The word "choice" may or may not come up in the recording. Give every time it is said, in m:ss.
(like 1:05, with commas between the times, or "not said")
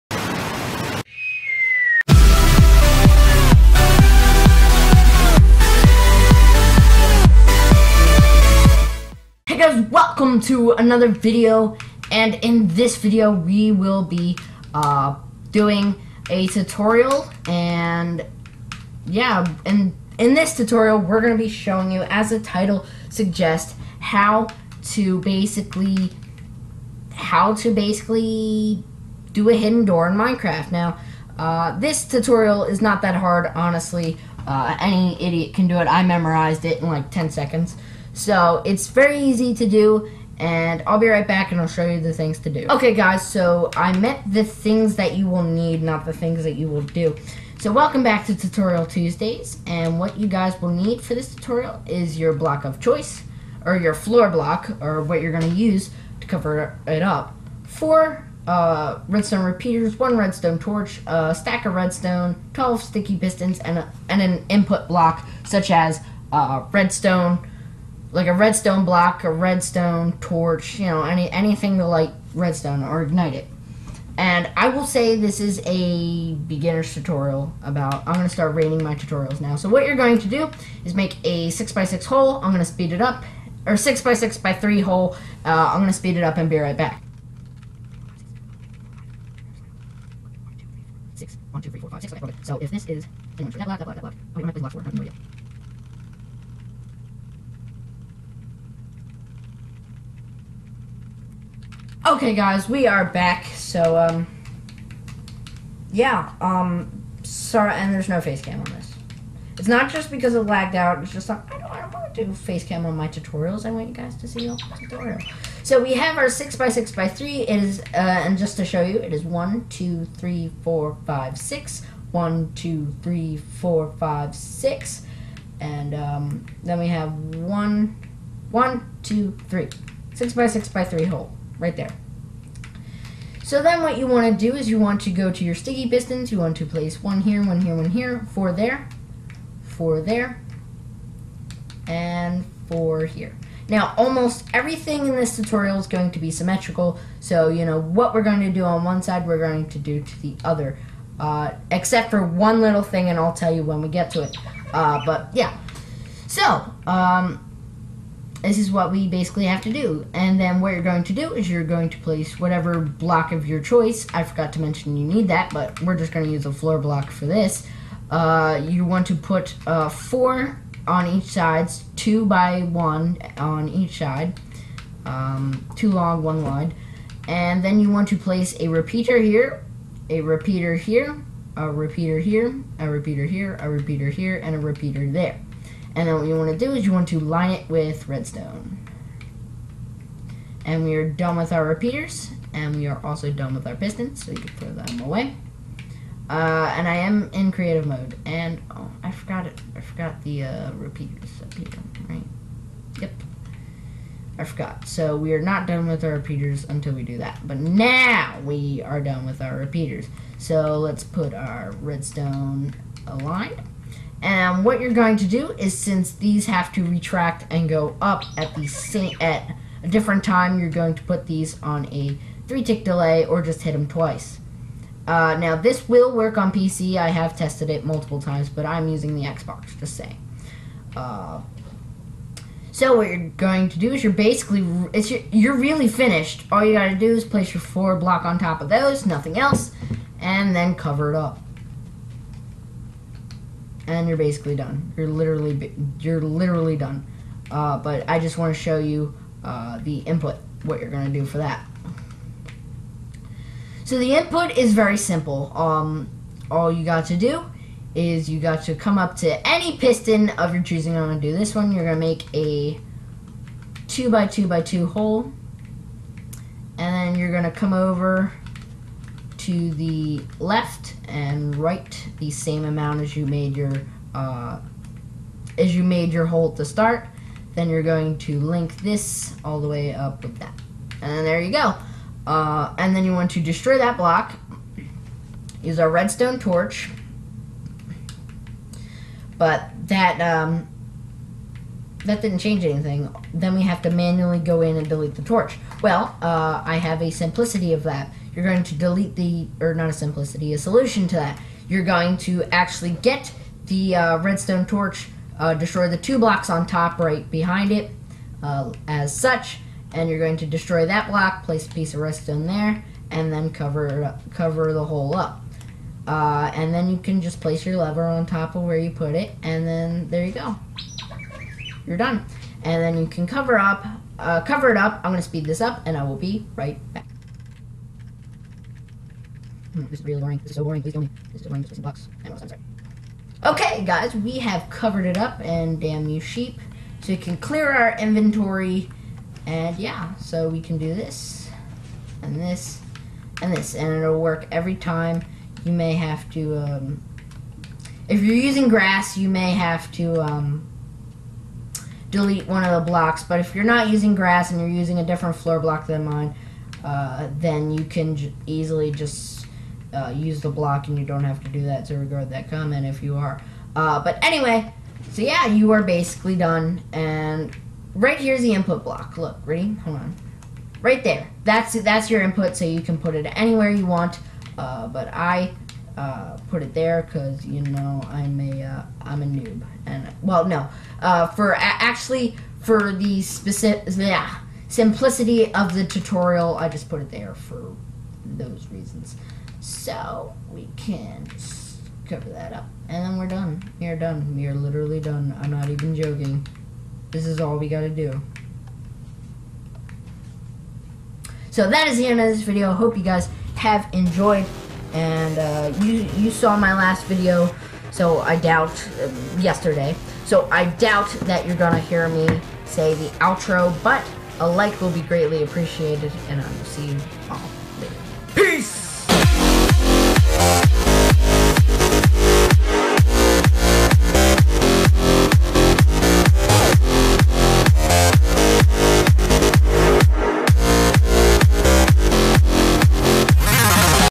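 0:52, 2:43.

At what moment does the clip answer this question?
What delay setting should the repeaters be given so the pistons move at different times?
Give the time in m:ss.
3:42.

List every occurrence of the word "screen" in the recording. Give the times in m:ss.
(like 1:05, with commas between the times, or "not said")
not said.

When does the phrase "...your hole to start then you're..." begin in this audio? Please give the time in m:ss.
4:36.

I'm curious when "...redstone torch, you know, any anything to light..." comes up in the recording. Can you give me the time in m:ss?
1:09.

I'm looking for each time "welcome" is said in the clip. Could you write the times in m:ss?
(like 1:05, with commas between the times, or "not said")
0:09, 0:47.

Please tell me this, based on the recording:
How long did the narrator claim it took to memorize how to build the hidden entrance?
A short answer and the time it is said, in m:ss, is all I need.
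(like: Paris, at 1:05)
10 seconds, at 0:37.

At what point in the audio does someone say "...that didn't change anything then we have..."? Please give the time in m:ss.
4:52.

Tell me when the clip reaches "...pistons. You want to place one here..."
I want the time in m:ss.
2:15.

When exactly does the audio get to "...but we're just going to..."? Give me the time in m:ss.
2:45.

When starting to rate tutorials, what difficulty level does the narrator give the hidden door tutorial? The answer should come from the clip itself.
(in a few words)
Beginner.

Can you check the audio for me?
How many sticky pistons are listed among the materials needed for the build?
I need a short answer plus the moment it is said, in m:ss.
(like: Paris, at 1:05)
12, at 1:02.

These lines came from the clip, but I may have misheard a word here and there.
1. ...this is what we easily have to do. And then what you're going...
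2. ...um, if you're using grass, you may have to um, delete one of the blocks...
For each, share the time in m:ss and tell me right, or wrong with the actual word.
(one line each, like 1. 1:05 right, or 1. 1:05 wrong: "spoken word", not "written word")
1. 2:38 wrong: "basically", not "easily"
2. 5:46 right.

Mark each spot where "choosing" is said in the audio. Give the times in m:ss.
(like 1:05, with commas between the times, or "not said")
4:20.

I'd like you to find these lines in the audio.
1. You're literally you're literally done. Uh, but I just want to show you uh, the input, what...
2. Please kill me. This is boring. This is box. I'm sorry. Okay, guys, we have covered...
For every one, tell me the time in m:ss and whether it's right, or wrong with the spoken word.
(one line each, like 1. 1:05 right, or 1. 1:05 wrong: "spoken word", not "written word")
1. 4:04 right
2. 5:30 right.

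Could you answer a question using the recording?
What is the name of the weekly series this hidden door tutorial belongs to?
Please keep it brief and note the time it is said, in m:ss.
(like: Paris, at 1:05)
Tutorial Tuesdays, at 0:48.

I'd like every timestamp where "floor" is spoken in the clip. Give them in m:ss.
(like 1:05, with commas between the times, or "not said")
0:53, 2:46, 5:55.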